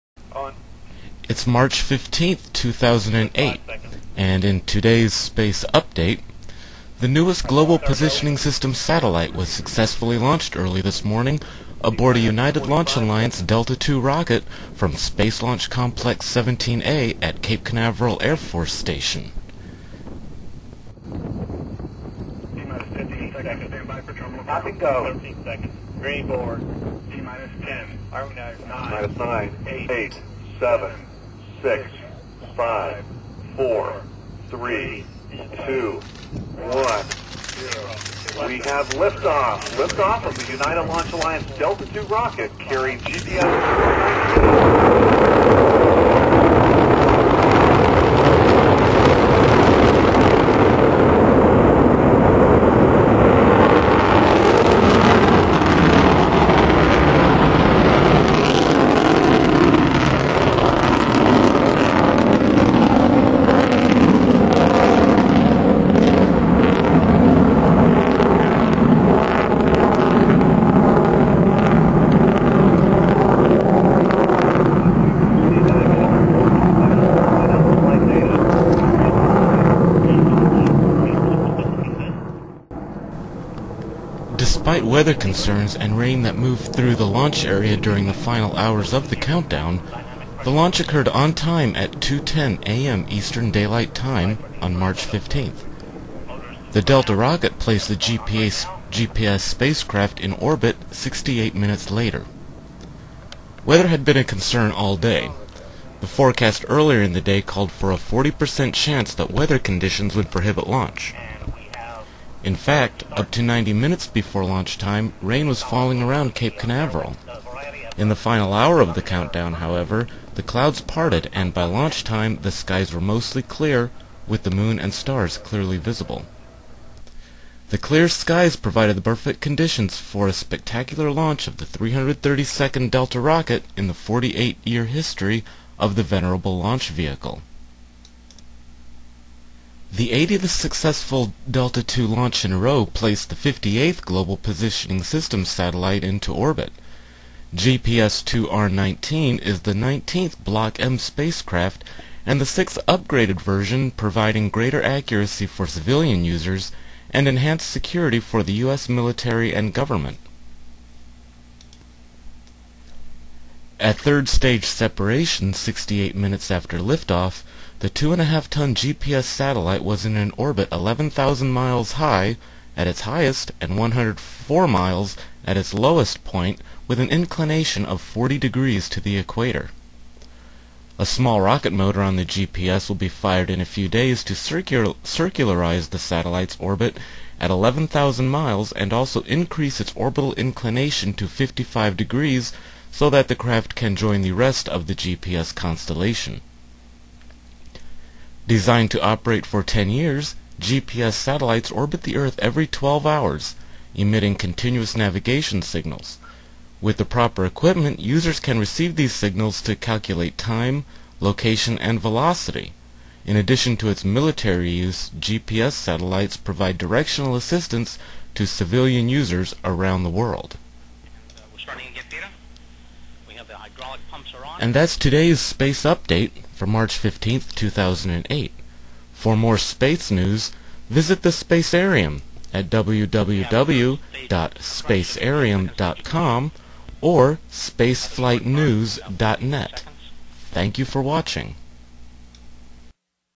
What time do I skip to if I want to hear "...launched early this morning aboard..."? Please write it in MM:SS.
00:10.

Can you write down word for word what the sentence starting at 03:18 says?
Designed to operate for 10 years, GPS satellites orbit the Earth every 12 hours, emitting continuous navigation signals.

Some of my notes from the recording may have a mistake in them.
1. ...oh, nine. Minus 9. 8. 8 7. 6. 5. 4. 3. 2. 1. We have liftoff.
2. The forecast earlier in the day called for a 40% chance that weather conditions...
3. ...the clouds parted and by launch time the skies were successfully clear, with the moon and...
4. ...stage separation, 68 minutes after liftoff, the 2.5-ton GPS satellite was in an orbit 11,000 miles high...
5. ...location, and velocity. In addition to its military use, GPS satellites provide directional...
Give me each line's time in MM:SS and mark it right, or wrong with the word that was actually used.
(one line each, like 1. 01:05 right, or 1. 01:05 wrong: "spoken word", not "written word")
1. 00:28 right
2. 01:45 right
3. 02:00 wrong: "mostly", not "successfully"
4. 02:44 right
5. 03:31 right.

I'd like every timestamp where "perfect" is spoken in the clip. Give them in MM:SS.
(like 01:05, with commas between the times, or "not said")
02:09.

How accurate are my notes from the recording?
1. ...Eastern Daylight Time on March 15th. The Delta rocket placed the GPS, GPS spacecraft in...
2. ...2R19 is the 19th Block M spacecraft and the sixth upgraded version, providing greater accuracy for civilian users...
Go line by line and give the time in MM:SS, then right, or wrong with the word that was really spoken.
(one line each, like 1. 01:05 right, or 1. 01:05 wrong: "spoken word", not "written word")
1. 01:33 right
2. 02:28 right.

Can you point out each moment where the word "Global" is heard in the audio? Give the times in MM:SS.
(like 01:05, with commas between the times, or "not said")
00:07, 02:23.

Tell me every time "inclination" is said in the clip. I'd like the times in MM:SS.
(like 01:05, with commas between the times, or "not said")
02:57, 03:10.